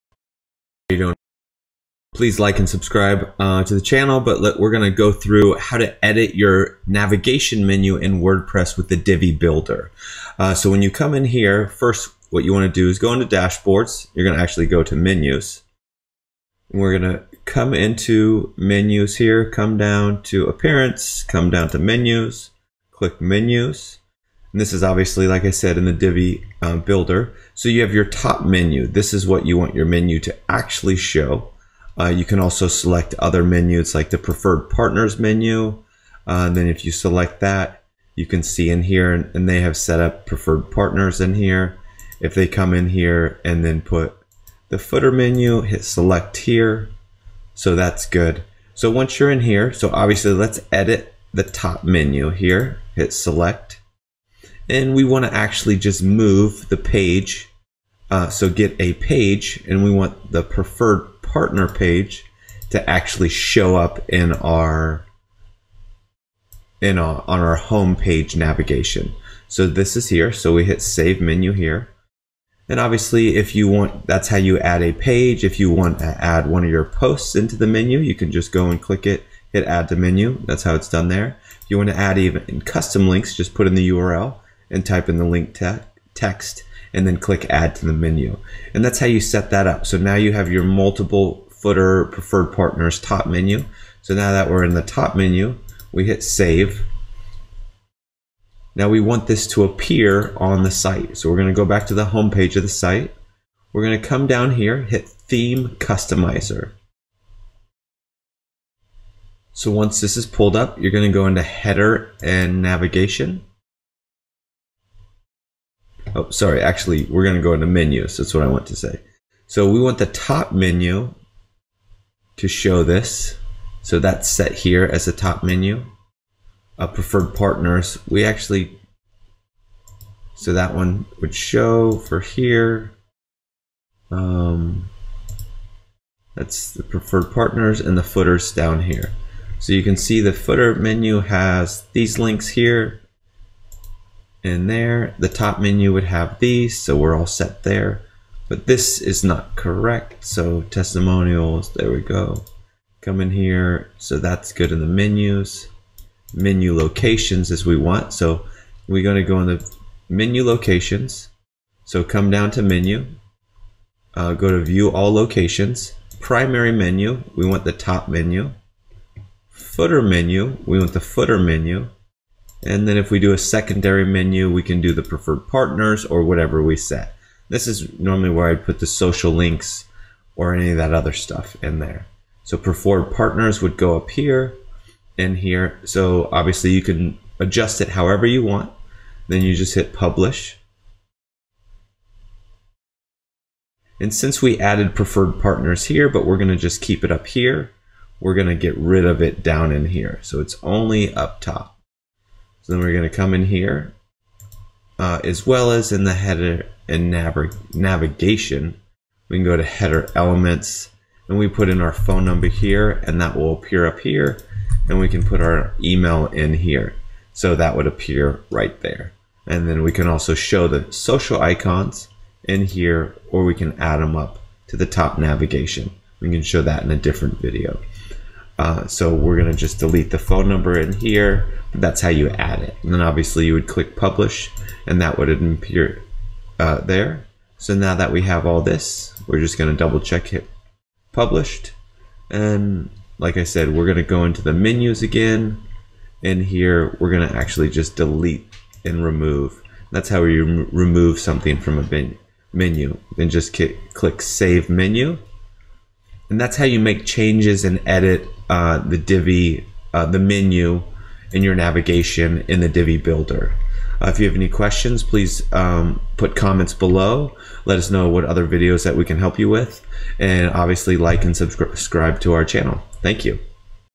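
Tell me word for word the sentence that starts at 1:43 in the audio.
We're gonna come down here, hit theme customizer.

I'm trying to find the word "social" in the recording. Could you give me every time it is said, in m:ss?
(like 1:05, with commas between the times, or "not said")
2:58, 3:40.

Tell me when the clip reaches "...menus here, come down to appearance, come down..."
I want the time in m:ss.
0:18.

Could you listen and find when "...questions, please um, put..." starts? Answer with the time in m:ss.
4:24.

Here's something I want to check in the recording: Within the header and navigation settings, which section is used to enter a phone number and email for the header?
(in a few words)
Header elements.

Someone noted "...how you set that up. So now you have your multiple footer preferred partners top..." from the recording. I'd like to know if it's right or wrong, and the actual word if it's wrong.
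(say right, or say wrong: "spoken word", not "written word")
right.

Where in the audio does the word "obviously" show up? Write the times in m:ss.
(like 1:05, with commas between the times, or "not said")
0:24, 0:49, 1:12, 3:06, 3:53, 4:30.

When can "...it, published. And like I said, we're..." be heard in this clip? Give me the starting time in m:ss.
4:00.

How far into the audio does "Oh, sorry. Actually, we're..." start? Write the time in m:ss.
1:56.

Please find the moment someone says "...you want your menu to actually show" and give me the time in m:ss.
0:29.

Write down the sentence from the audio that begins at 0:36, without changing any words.
Uh, and then if you select that, you can see in here and, and they have set up preferred partners in here.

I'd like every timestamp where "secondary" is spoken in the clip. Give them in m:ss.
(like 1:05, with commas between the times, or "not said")
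2:53.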